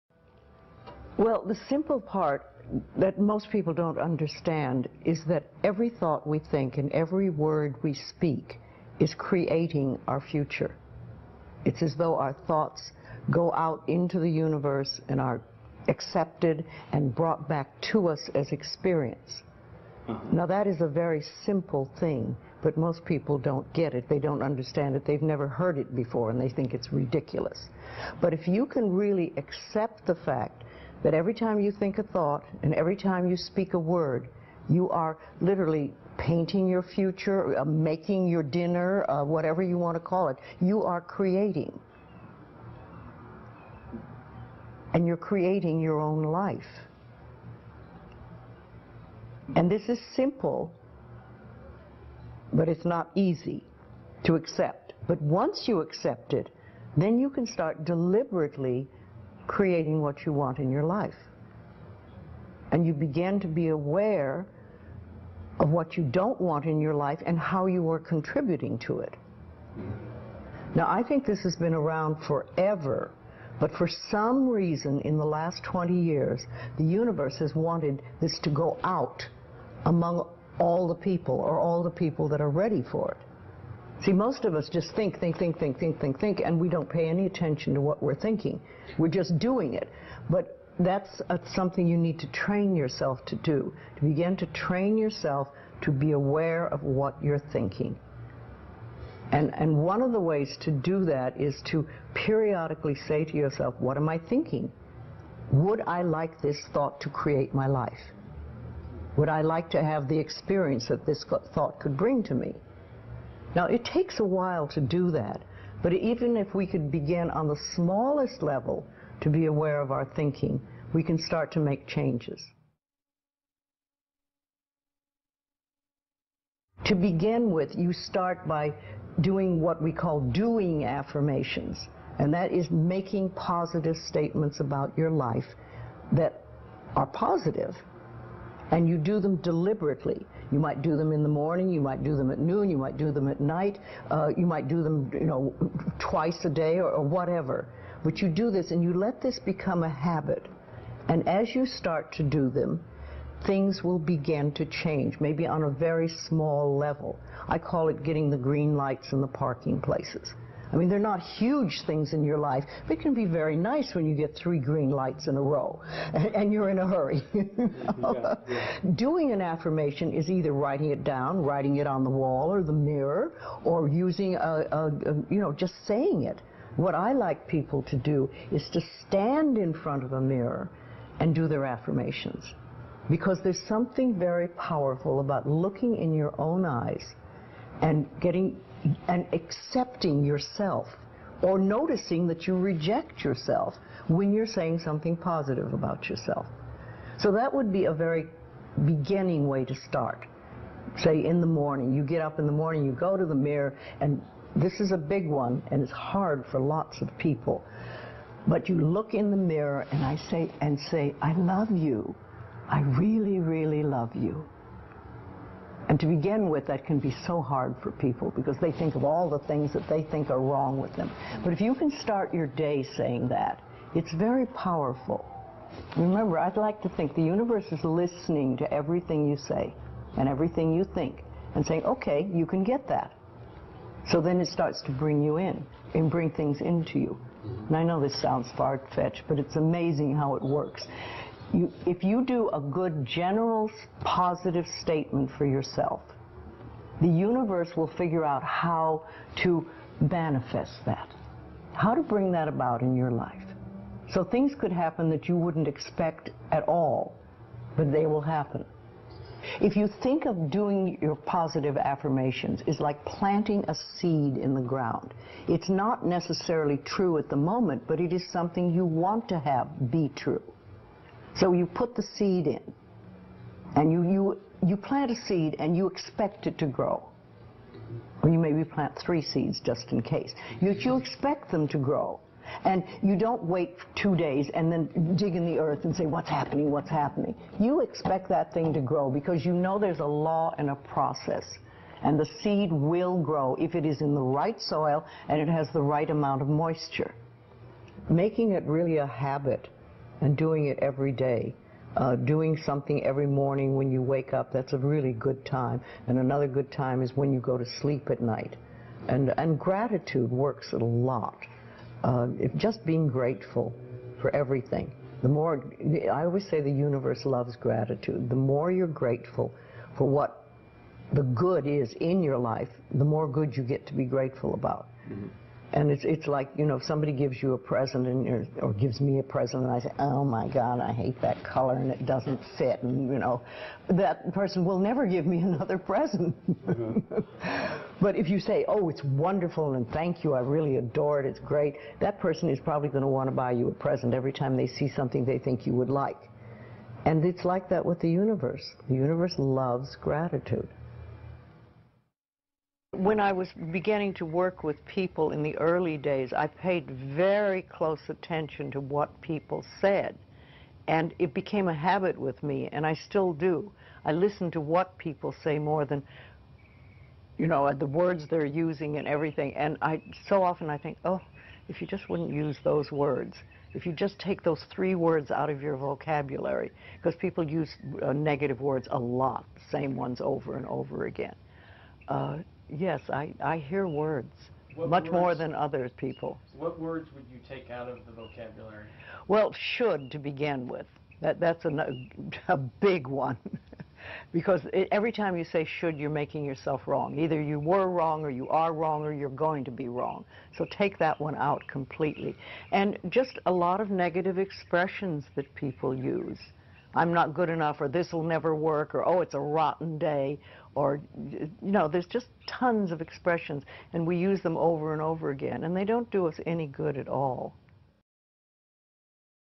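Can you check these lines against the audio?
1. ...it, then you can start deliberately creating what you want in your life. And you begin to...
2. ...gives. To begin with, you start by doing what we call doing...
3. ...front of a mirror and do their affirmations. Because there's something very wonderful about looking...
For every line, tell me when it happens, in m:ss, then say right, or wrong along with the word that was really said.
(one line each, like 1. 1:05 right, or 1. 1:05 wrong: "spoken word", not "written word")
1. 0:56 right
2. 2:01 wrong: "changes", not "gives"
3. 2:59 wrong: "powerful", not "wonderful".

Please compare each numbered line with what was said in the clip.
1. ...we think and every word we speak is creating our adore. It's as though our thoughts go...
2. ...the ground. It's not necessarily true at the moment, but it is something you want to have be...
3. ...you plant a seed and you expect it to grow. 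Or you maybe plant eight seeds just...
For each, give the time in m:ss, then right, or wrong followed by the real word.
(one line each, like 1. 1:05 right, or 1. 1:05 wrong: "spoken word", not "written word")
1. 0:06 wrong: "future", not "adore"
2. 4:24 right
3. 4:34 wrong: "three", not "eight".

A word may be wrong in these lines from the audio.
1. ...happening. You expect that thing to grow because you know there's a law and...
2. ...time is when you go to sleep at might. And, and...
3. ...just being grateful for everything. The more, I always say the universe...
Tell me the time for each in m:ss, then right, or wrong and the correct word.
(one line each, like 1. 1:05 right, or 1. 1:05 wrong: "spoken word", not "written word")
1. 4:46 right
2. 5:06 wrong: "night", not "might"
3. 5:12 right.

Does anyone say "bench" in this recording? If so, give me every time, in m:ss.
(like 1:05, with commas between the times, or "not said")
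not said.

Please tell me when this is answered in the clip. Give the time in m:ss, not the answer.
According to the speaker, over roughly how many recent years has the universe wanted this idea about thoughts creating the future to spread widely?
1:15.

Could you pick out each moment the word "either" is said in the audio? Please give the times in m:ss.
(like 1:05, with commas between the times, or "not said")
2:50, 6:37.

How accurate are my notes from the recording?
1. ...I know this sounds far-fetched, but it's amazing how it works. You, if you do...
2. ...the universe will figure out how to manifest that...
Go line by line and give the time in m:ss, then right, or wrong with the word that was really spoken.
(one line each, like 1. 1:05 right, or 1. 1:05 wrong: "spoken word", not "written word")
1. 3:57 right
2. 4:07 right.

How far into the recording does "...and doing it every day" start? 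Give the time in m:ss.
5:00.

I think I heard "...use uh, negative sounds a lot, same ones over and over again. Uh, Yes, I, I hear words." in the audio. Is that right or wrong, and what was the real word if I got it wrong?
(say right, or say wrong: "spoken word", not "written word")
wrong: "words", not "sounds".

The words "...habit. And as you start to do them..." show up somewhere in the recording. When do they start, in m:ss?
2:29.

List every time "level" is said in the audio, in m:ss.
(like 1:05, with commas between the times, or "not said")
1:58, 2:36.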